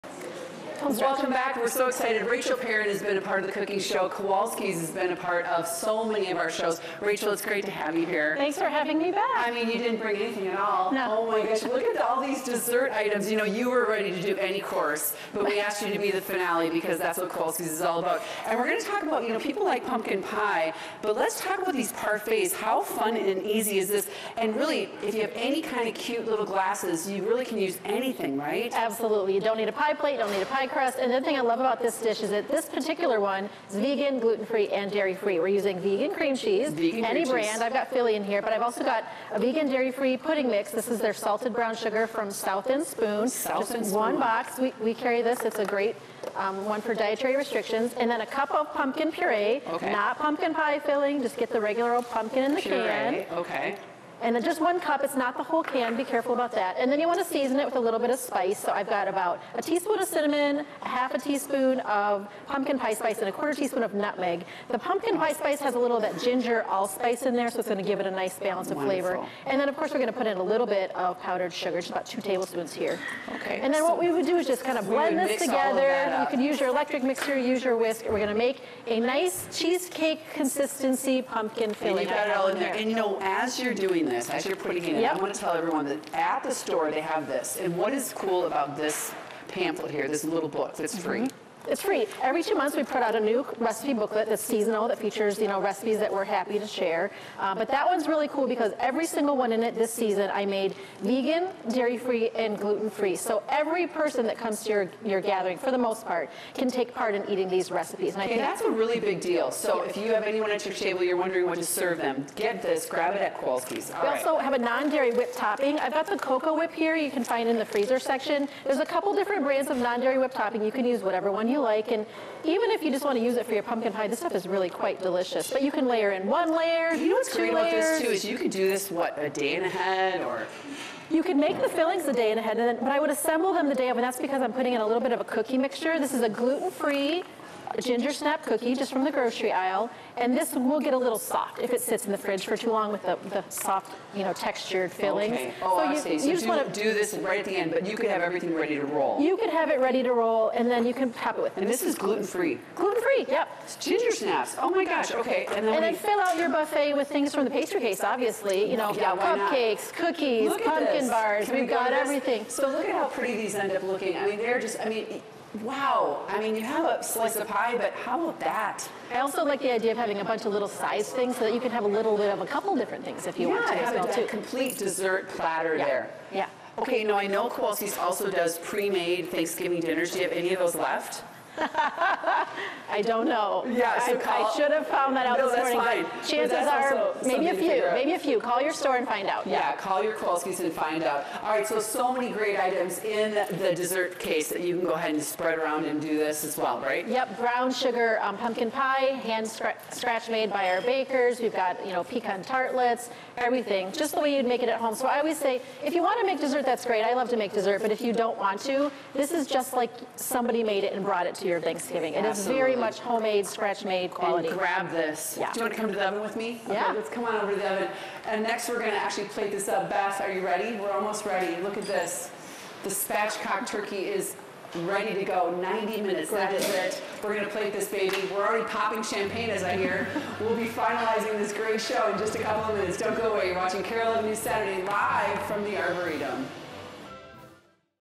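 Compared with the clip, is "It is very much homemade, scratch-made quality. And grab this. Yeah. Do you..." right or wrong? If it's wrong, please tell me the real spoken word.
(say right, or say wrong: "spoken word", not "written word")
right.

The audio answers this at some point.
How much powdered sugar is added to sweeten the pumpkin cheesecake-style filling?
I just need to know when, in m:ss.
1:12.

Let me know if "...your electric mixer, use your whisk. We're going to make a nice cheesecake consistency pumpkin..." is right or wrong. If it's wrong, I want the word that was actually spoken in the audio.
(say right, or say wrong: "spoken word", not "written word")
right.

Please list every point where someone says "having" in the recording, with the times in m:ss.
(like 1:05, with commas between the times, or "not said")
0:08, 2:49.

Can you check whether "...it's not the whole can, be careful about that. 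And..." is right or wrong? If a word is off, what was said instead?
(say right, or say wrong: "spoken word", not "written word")
right.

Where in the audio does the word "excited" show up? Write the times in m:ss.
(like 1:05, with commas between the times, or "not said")
0:01.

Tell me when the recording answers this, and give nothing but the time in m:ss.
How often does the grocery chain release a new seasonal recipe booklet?
1:32.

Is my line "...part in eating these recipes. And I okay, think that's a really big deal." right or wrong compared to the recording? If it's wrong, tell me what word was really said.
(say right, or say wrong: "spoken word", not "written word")
right.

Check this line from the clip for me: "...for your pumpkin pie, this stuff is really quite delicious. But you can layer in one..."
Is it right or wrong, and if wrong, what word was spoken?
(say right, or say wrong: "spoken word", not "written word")
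right.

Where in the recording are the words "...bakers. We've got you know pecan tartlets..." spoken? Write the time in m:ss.
3:20.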